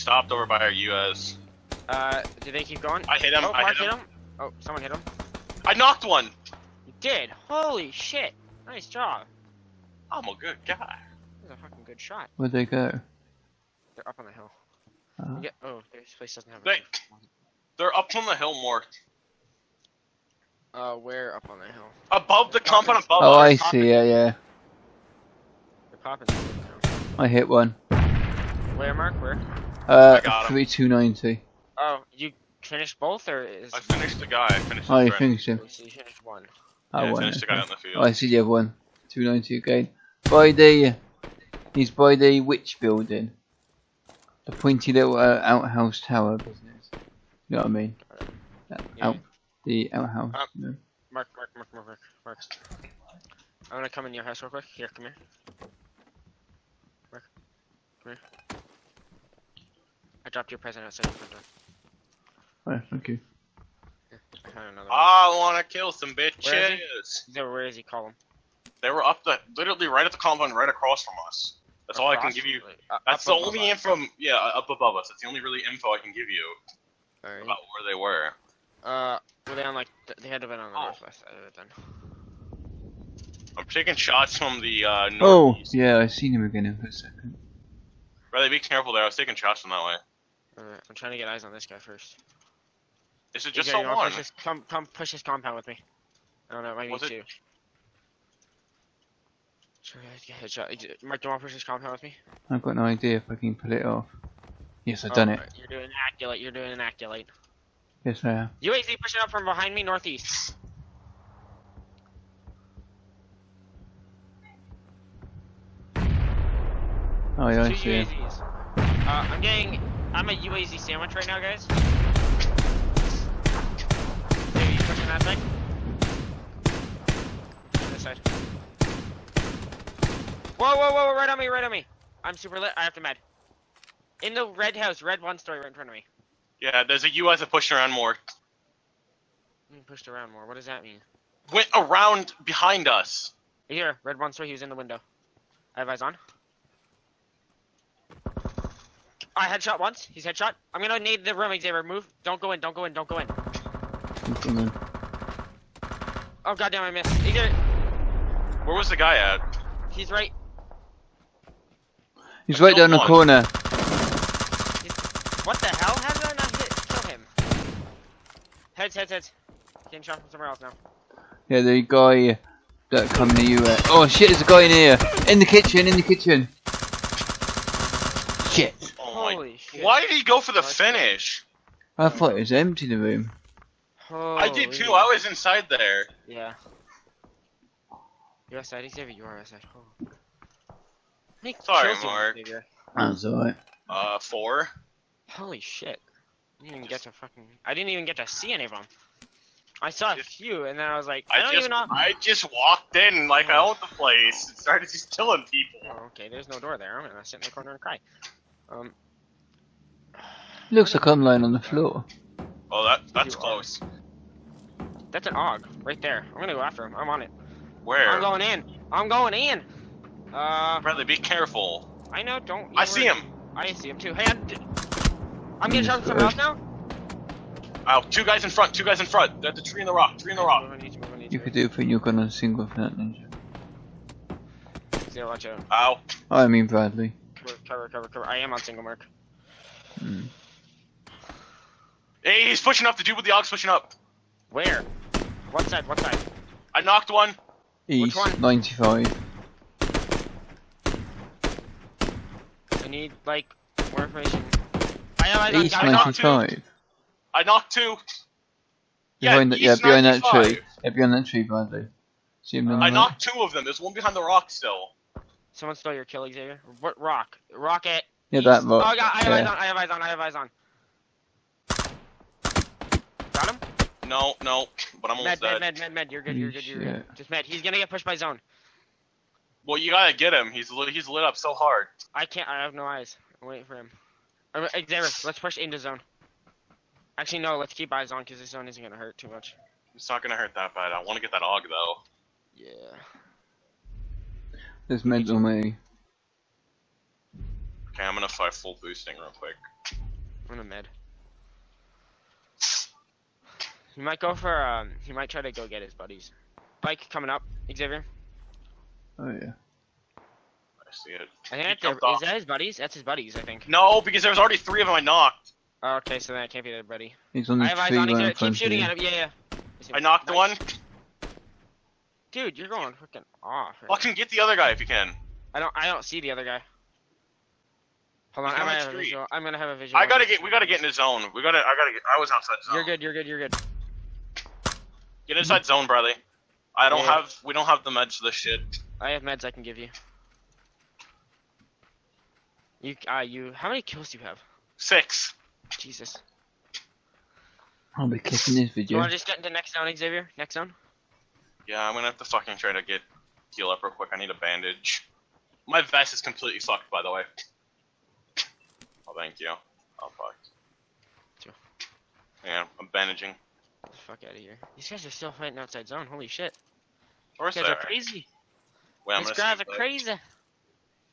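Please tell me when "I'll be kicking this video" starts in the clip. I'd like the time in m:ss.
5:47.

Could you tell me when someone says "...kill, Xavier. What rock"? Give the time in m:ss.
4:26.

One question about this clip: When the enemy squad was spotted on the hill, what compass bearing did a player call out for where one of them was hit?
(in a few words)
290.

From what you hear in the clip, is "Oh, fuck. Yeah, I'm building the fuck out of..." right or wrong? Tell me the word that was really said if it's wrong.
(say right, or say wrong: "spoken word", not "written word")
wrong: "bandaging", not "building".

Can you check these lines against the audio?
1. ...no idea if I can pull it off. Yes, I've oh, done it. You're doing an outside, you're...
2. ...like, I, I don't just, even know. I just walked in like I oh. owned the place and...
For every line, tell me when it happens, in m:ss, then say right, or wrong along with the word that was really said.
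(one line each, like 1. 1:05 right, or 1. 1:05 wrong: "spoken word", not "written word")
1. 1:42 wrong: "accolade", not "outside"
2. 3:21 right.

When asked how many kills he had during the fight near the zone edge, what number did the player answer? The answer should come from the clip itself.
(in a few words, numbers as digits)
6.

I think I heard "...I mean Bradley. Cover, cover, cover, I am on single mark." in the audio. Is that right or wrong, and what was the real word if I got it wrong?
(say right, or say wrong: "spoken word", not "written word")
right.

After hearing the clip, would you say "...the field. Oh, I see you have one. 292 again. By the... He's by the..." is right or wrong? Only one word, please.
right.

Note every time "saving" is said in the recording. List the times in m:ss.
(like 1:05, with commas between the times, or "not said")
not said.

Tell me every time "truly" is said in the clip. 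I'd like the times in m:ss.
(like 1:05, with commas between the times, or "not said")
not said.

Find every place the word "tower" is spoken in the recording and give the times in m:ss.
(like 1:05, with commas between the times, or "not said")
0:46.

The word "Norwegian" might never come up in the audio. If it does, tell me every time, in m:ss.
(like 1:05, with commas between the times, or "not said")
not said.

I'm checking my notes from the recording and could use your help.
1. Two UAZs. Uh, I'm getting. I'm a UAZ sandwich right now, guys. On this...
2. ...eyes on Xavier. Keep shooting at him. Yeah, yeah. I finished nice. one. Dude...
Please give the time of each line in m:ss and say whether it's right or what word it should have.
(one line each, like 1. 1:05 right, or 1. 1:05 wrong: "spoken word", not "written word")
1. 1:58 right
2. 5:17 wrong: "knocked", not "finished".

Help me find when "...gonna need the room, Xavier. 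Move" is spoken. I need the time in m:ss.
2:30.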